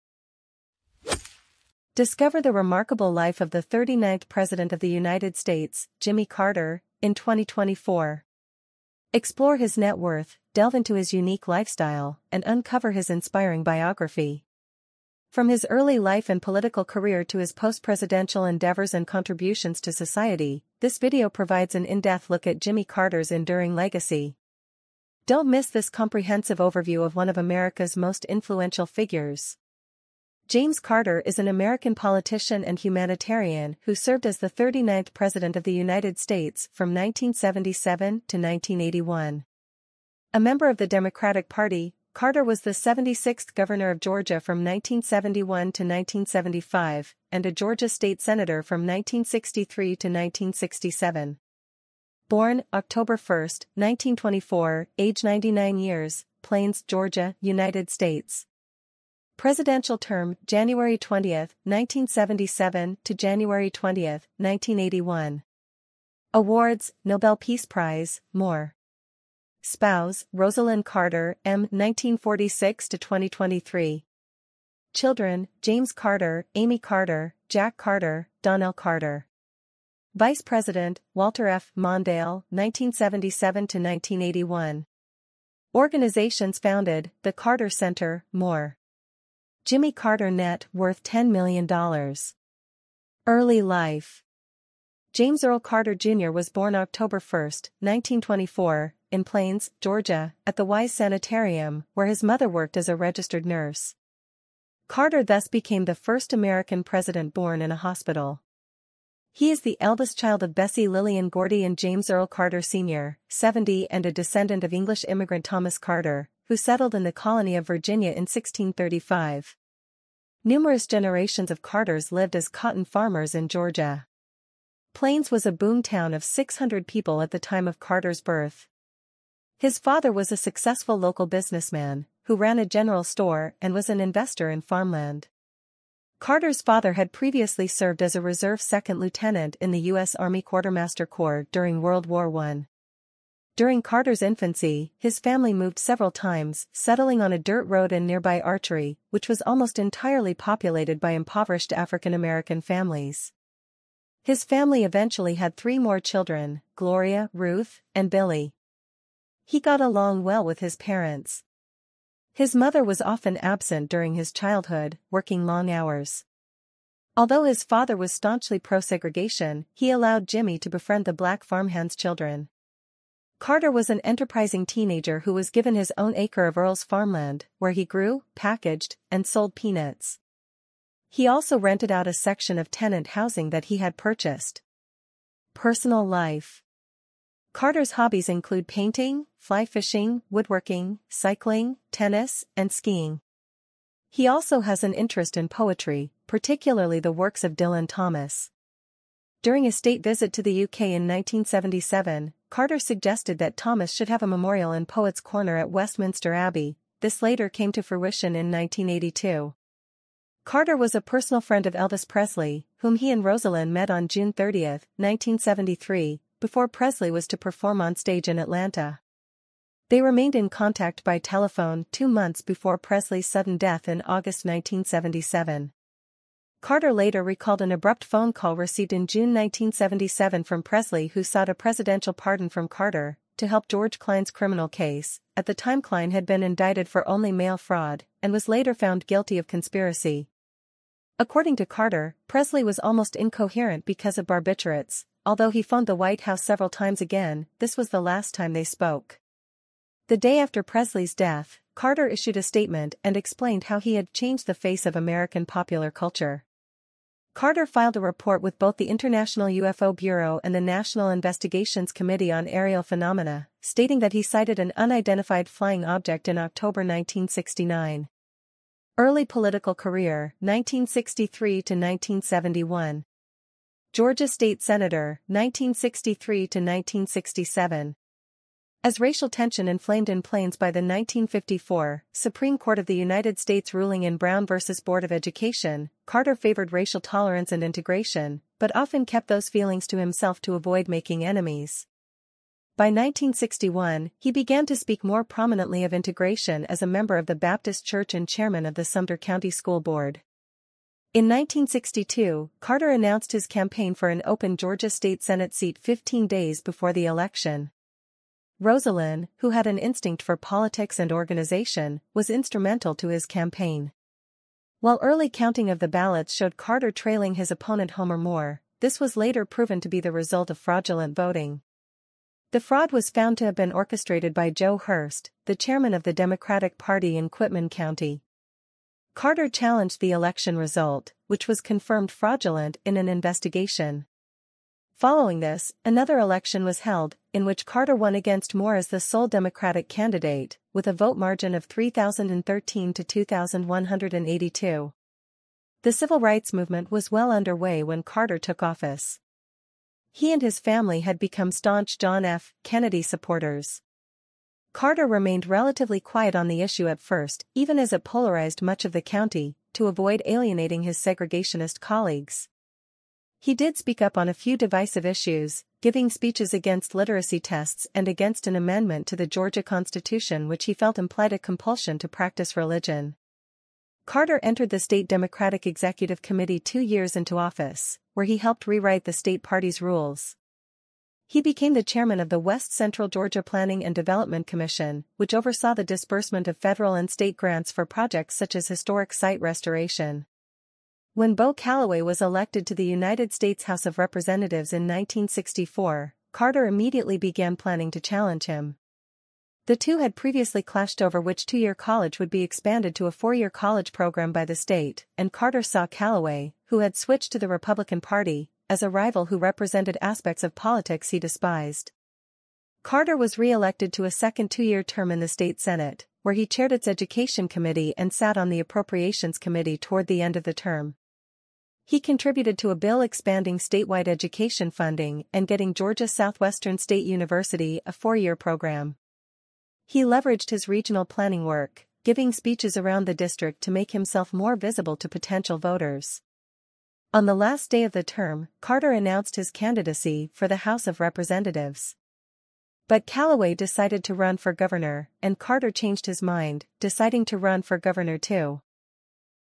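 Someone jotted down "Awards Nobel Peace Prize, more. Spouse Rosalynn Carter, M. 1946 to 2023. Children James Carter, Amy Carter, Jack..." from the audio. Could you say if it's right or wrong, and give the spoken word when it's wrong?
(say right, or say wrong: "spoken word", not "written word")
right.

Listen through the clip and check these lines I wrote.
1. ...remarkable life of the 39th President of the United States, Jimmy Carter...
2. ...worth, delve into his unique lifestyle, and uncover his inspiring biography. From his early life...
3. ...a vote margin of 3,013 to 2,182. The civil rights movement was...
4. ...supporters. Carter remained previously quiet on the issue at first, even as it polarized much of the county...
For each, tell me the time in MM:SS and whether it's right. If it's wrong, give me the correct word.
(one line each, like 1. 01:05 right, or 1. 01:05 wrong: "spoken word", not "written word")
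1. 00:02 right
2. 00:09 right
3. 05:40 right
4. 05:53 wrong: "relatively", not "previously".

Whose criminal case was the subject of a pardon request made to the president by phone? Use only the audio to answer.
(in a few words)
George Klein.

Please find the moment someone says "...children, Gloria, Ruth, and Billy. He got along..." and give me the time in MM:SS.
02:35.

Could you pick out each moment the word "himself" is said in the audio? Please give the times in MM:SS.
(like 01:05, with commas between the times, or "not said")
04:49, 07:13.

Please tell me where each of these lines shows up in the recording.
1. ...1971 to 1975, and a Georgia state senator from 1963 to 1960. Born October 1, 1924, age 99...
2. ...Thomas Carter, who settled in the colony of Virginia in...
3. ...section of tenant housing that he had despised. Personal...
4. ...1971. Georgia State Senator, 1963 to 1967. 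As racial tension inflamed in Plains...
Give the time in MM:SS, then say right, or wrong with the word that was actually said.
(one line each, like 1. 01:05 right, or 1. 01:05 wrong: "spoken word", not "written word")
1. 00:44 wrong: "1967", not "1960"
2. 01:55 right
3. 03:02 wrong: "purchased", not "despised"
4. 04:31 right.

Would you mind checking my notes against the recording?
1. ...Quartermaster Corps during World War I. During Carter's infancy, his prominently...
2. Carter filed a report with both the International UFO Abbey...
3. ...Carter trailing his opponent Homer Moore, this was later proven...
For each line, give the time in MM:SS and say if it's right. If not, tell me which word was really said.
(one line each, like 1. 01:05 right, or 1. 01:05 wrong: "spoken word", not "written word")
1. 02:20 wrong: "family", not "prominently"
2. 04:17 wrong: "Bureau", not "Abbey"
3. 05:16 right.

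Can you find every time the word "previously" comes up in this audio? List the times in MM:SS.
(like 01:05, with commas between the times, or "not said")
02:17, 06:40.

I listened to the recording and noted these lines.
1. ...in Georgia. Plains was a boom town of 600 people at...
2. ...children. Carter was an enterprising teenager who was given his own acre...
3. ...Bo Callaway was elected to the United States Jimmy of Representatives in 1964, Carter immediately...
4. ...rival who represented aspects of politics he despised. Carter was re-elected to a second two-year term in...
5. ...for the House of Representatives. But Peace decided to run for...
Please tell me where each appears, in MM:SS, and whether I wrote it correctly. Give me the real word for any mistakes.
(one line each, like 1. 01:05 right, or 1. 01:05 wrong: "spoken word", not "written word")
1. 02:03 right
2. 02:51 right
3. 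06:31 wrong: "House", not "Jimmy"
4. 06:48 right
5. 07:20 wrong: "Callaway", not "Peace".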